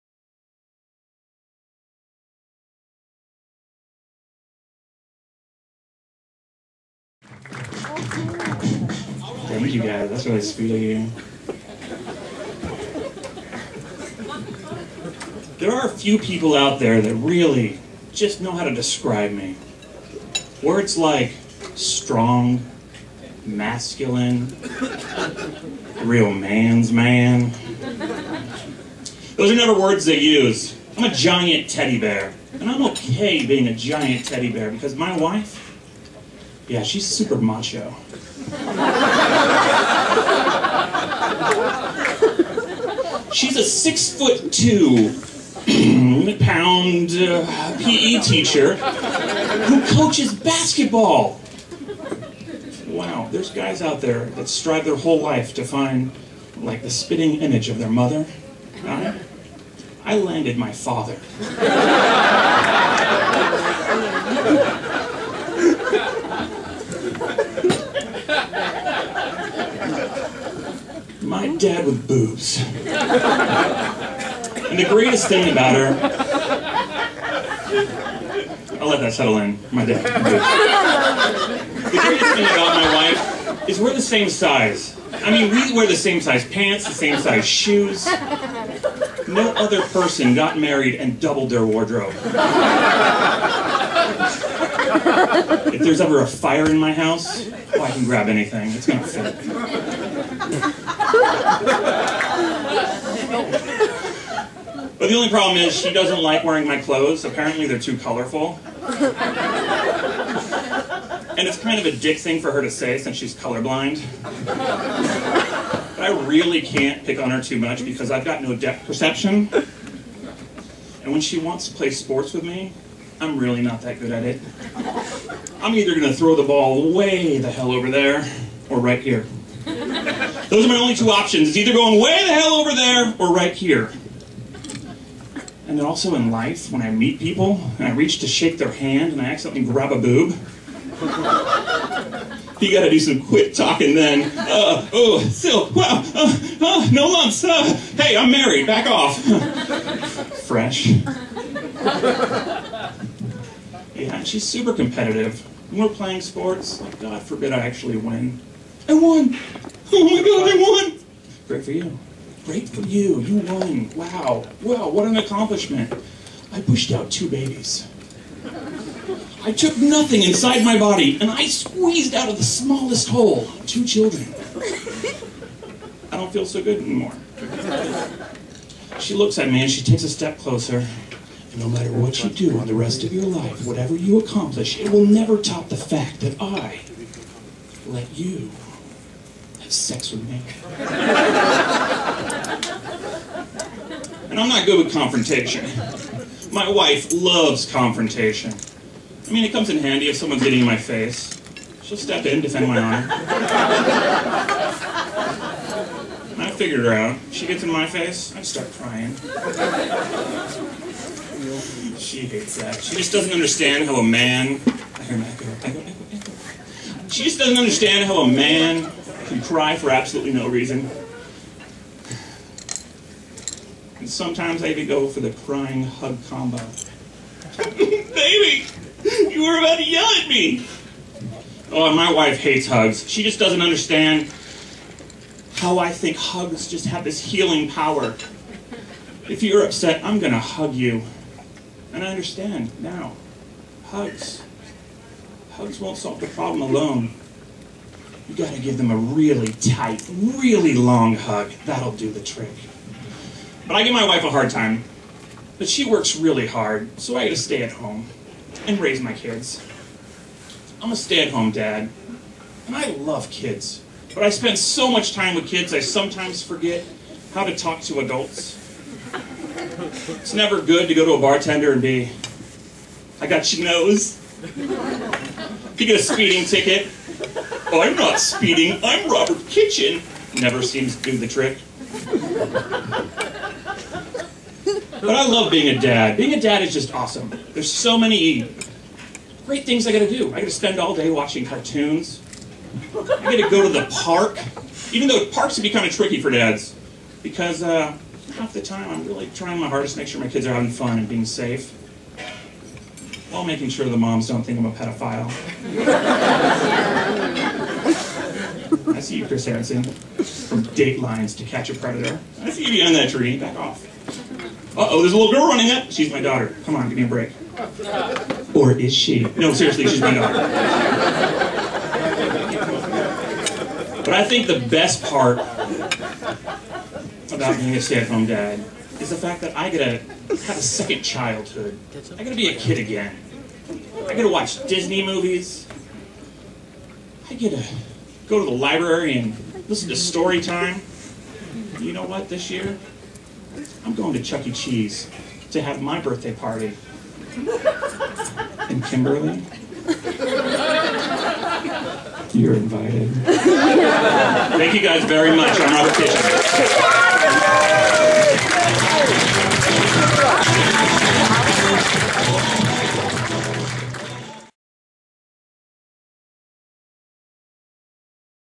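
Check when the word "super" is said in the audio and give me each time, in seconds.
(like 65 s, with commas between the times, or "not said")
37 s, 154 s.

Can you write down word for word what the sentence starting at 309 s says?
From Dateline's to Catch a Predator.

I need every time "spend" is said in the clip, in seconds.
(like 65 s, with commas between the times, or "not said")
264 s, 290 s.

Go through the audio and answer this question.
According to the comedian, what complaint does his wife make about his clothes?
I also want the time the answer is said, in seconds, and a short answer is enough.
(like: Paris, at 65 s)
Too colorful, at 107 s.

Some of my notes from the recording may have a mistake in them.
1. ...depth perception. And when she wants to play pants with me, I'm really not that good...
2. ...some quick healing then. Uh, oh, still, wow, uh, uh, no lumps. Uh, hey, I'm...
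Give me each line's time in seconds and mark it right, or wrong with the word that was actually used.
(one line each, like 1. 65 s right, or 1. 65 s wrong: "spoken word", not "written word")
1. 118 s wrong: "sports", not "pants"
2. 142 s wrong: "talking", not "healing".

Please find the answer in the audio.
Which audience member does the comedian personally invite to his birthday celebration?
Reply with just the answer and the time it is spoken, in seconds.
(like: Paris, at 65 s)
Kimberly, at 348 s.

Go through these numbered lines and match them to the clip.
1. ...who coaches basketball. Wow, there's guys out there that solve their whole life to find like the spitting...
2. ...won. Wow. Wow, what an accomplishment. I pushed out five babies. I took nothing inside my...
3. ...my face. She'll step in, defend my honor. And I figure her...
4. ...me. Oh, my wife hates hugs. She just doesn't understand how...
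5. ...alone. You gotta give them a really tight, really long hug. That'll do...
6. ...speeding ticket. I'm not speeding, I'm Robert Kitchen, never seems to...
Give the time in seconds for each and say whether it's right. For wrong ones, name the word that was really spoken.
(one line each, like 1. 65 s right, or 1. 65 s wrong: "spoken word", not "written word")
1. 48 s wrong: "strive", not "solve"
2. 163 s wrong: "two", not "five"
3. 200 s right
4. 230 s right
5. 246 s right
6. 276 s right.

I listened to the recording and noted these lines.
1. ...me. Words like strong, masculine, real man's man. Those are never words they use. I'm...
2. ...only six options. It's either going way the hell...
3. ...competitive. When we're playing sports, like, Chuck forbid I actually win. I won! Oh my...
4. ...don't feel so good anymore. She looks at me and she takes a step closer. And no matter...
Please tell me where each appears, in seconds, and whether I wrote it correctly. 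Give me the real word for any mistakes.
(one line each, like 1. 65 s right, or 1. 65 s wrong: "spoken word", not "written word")
1. 19 s right
2. 130 s wrong: "two", not "six"
3. 154 s wrong: "God", not "Chuck"
4. 176 s right.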